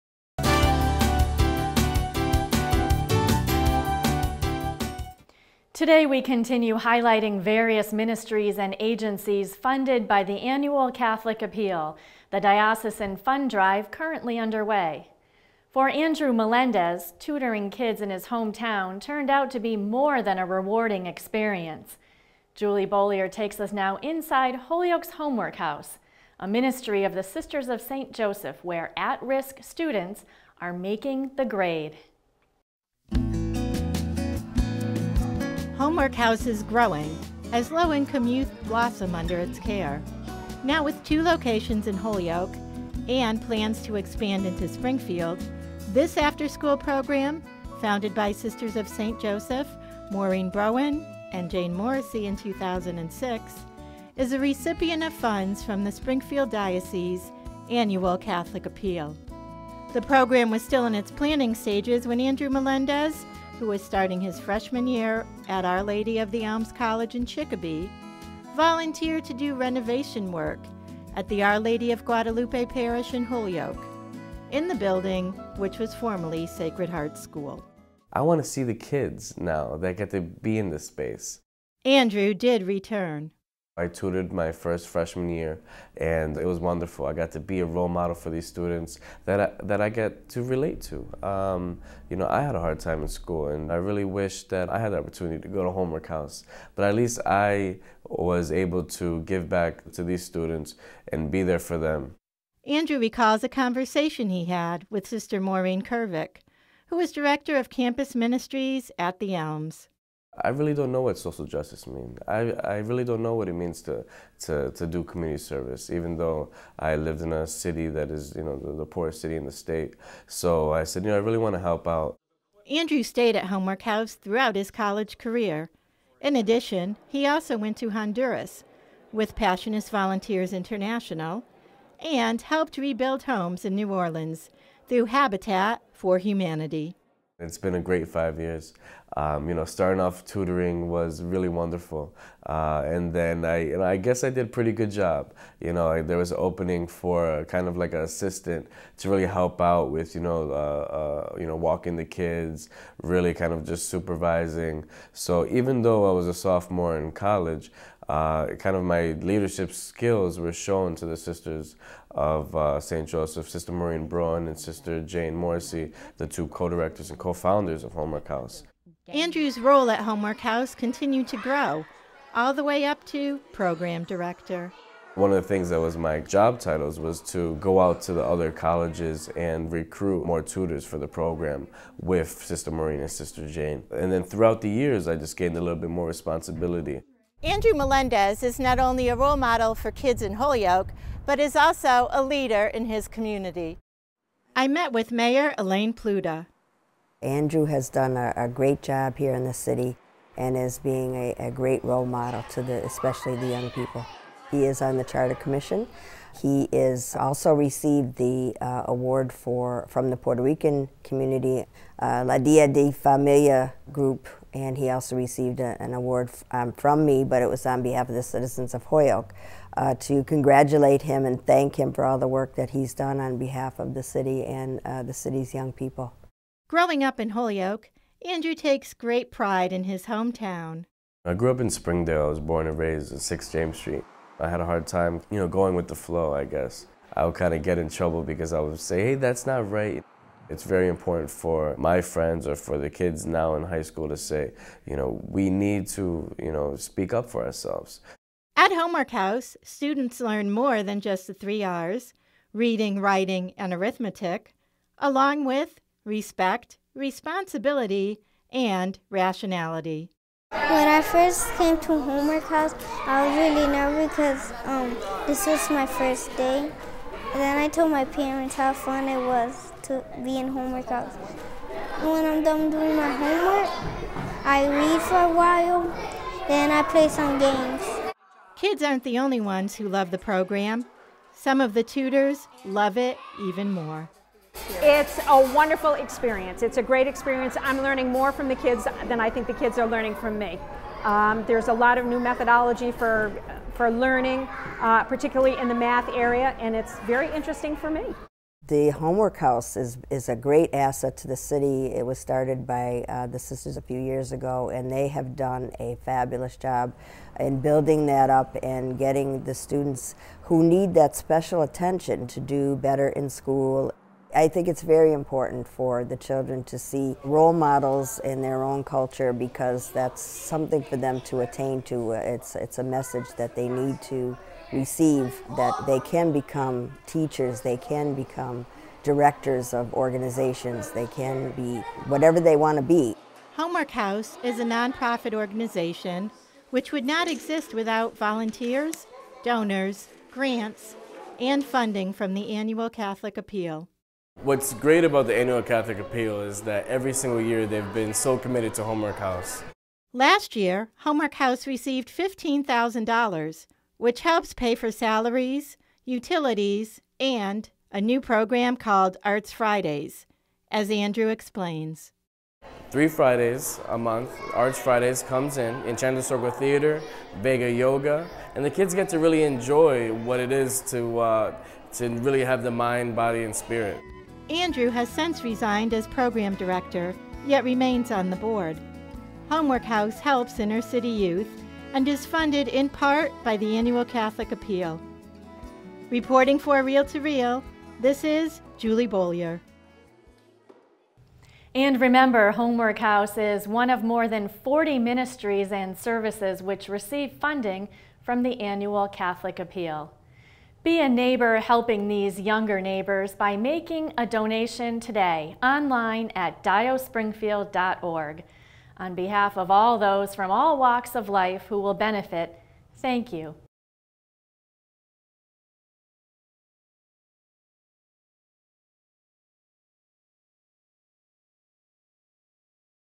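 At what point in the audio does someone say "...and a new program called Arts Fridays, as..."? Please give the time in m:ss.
5:57.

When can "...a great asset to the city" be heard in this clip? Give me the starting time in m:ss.
5:00.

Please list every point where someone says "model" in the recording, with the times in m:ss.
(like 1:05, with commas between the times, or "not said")
1:27, 3:09, 3:22, 5:17.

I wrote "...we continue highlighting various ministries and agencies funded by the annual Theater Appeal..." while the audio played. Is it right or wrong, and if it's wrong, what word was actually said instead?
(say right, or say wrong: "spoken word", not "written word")
wrong: "Catholic", not "Theater".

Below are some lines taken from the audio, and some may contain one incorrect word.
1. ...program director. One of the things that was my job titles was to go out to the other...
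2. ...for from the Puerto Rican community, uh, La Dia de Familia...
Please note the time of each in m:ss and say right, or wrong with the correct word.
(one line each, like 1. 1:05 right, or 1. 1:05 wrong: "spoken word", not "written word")
1. 2:53 right
2. 3:29 right.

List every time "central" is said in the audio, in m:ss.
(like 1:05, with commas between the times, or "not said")
not said.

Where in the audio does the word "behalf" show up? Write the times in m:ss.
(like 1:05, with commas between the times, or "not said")
3:37, 3:43, 6:49.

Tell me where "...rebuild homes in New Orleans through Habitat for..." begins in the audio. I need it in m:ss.
2:12.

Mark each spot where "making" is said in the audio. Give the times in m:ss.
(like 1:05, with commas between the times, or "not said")
0:30, 6:43.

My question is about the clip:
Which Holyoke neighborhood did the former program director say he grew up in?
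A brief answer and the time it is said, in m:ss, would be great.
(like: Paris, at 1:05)
Springdale, at 3:51.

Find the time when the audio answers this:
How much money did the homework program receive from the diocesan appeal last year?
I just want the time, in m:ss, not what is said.
5:52.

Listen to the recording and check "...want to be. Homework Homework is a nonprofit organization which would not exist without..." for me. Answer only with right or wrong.
wrong.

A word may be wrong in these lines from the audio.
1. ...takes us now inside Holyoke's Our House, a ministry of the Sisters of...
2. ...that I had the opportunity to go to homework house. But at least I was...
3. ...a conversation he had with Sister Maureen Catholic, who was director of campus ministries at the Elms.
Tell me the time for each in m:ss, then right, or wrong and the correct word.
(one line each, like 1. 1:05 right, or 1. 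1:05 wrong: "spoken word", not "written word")
1. 0:23 wrong: "Homework", not "Our"
2. 1:34 right
3. 1:43 wrong: "Kervick", not "Catholic".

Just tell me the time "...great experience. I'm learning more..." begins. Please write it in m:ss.
4:46.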